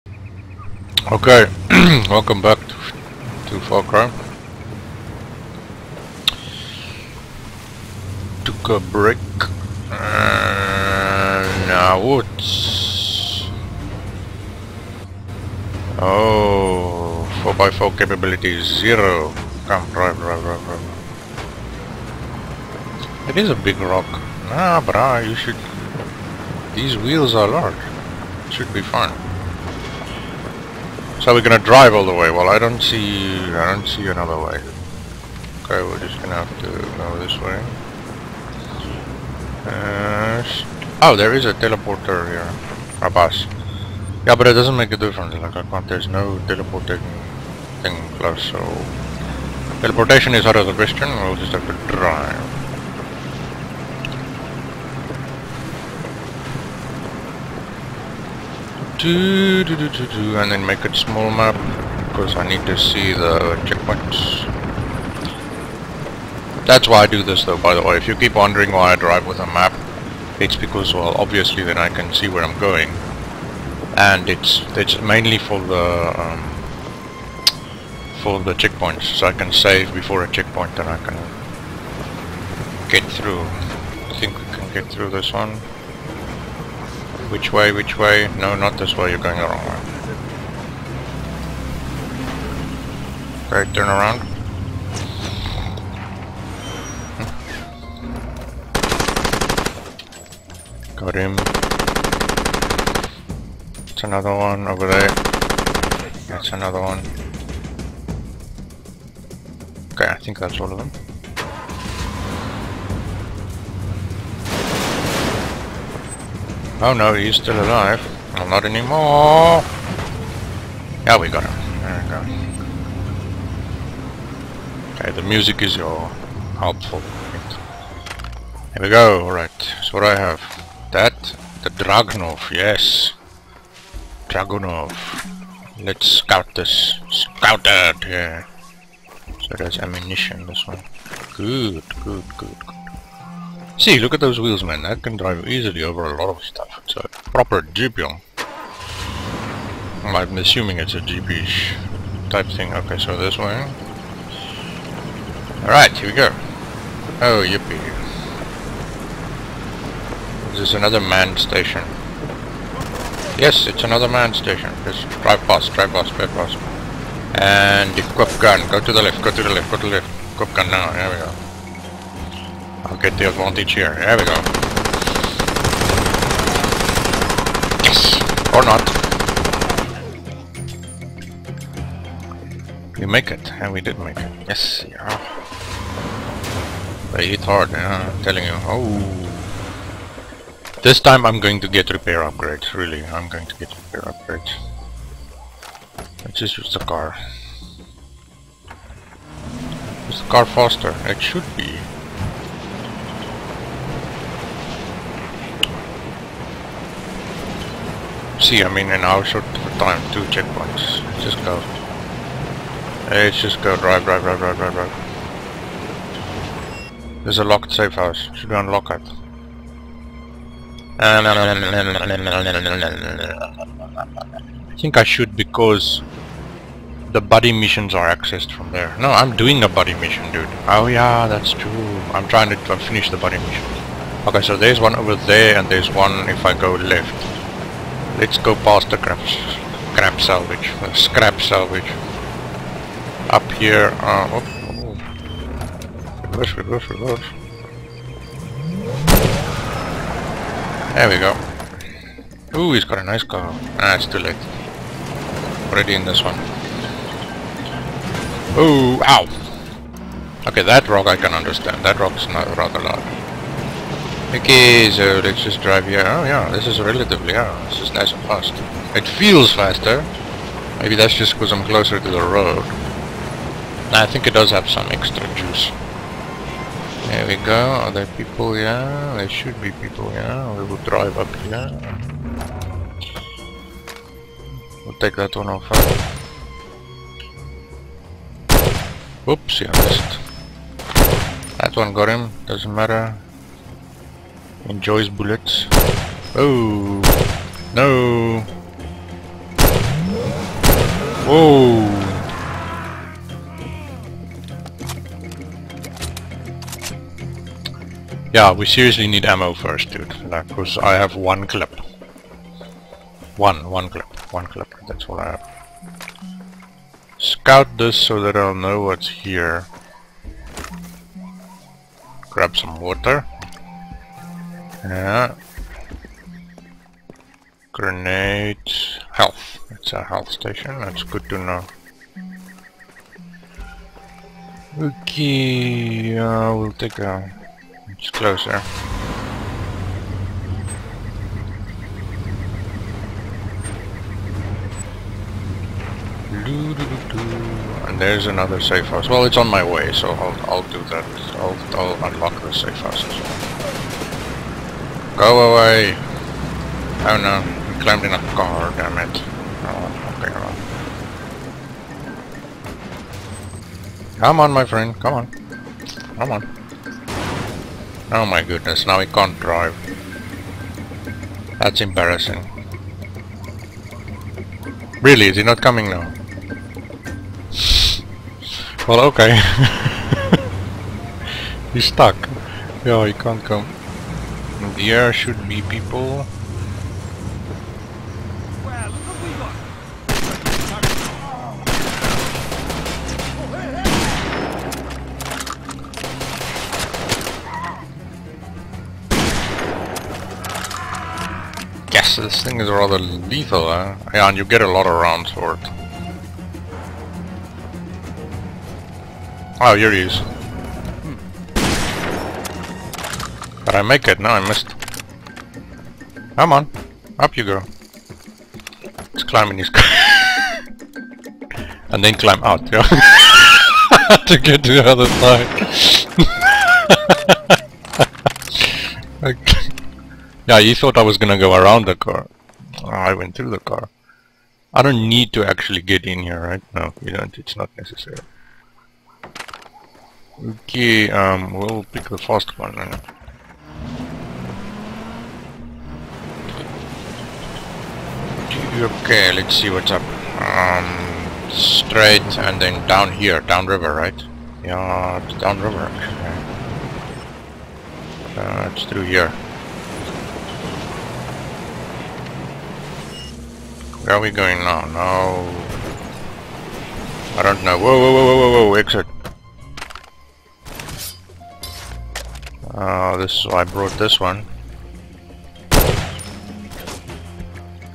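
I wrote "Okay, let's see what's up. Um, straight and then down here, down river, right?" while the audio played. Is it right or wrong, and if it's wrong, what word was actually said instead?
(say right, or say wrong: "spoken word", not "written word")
right.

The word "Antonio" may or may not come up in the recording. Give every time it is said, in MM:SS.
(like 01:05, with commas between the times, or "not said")
not said.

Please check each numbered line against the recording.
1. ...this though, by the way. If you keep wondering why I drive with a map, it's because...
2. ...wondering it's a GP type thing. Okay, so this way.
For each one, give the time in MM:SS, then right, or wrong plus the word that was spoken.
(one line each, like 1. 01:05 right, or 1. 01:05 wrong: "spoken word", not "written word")
1. 01:07 right
2. 02:30 wrong: "assuming", not "wondering".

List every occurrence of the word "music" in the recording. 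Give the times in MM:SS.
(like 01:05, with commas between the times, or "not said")
02:05.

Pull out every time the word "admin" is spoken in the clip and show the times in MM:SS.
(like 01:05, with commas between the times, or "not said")
not said.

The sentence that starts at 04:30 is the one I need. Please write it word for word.
Maybe that's just because I'm closer to the road.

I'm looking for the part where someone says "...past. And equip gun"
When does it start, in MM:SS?
02:46.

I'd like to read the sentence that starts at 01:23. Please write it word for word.
I think we can get through this one.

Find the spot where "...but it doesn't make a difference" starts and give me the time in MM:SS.
00:44.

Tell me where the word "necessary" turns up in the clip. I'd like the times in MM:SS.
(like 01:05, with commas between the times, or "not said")
07:17.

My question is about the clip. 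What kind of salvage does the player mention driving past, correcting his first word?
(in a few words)
Scrap salvage.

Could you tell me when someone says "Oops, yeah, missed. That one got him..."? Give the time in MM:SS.
04:49.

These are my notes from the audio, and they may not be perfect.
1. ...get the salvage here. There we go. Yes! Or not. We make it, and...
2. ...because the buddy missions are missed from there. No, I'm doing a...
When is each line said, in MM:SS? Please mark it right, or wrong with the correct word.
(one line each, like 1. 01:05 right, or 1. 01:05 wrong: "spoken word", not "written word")
1. 02:52 wrong: "advantage", not "salvage"
2. 03:45 wrong: "accessed", not "missed".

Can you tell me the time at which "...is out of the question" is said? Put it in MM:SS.
00:50.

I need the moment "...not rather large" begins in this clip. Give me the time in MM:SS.
04:22.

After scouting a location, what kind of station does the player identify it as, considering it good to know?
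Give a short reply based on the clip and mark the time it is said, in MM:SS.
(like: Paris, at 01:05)
Health station, at 05:30.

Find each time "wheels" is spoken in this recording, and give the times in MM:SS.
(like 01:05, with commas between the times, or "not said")
00:26, 02:24.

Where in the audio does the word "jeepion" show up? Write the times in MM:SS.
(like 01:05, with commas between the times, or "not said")
02:27.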